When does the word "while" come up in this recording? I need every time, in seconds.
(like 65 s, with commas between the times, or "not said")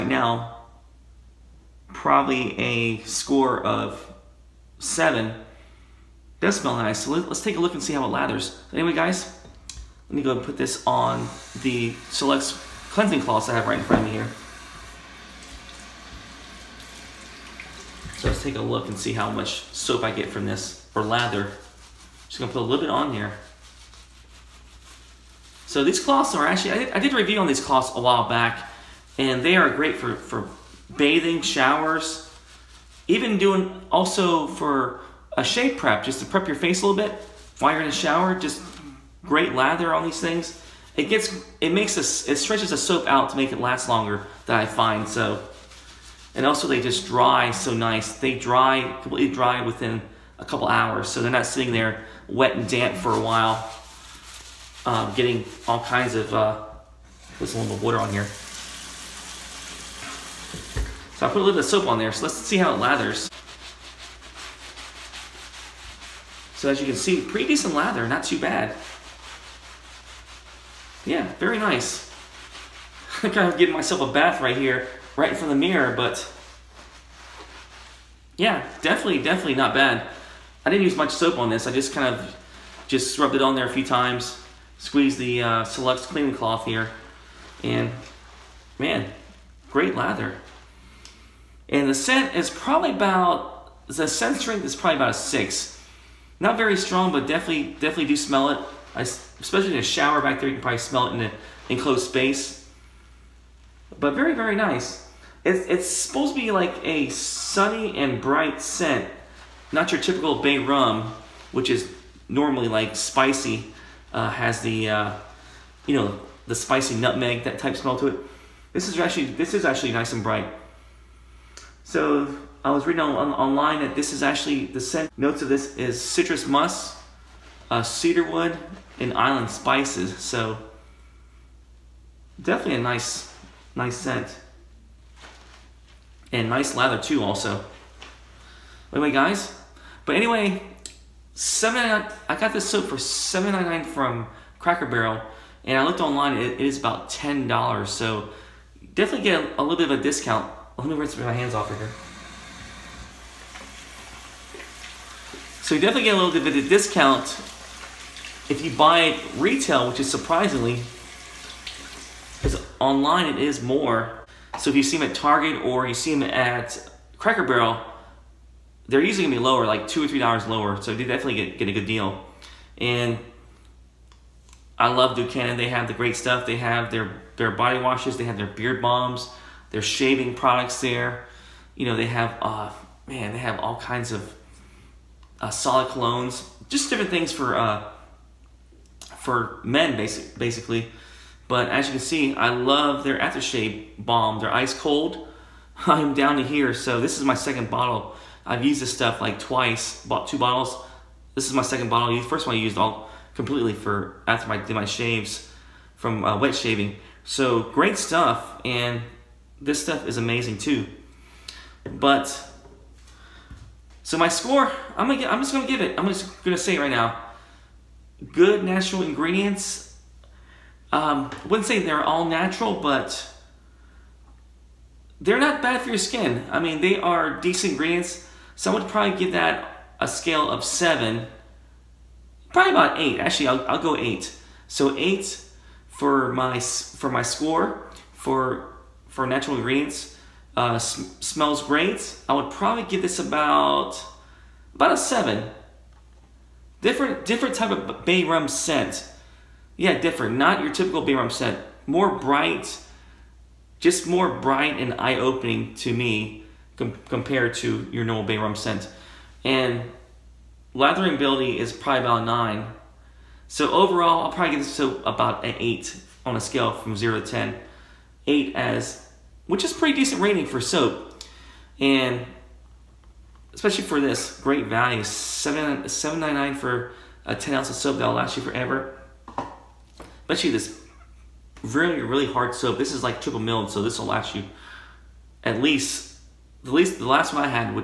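28 s, 37 s, 53 s.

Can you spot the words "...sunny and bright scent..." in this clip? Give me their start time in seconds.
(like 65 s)
107 s.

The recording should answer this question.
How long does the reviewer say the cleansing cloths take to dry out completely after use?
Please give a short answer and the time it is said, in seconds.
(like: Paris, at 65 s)
A couple hours, at 50 s.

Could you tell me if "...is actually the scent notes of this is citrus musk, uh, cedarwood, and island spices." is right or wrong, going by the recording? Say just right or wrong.
right.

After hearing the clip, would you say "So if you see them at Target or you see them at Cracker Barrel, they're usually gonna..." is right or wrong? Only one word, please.
right.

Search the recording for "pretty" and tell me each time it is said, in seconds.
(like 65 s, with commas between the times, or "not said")
67 s, 269 s.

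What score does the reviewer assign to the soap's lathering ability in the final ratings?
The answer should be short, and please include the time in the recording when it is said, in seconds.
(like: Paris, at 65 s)
9, at 262 s.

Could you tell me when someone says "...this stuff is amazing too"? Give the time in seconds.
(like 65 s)
209 s.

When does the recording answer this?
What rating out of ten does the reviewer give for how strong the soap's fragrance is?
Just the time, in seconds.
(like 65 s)
95 s.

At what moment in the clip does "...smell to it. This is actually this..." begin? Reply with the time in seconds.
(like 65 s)
117 s.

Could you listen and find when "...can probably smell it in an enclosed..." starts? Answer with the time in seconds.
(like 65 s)
100 s.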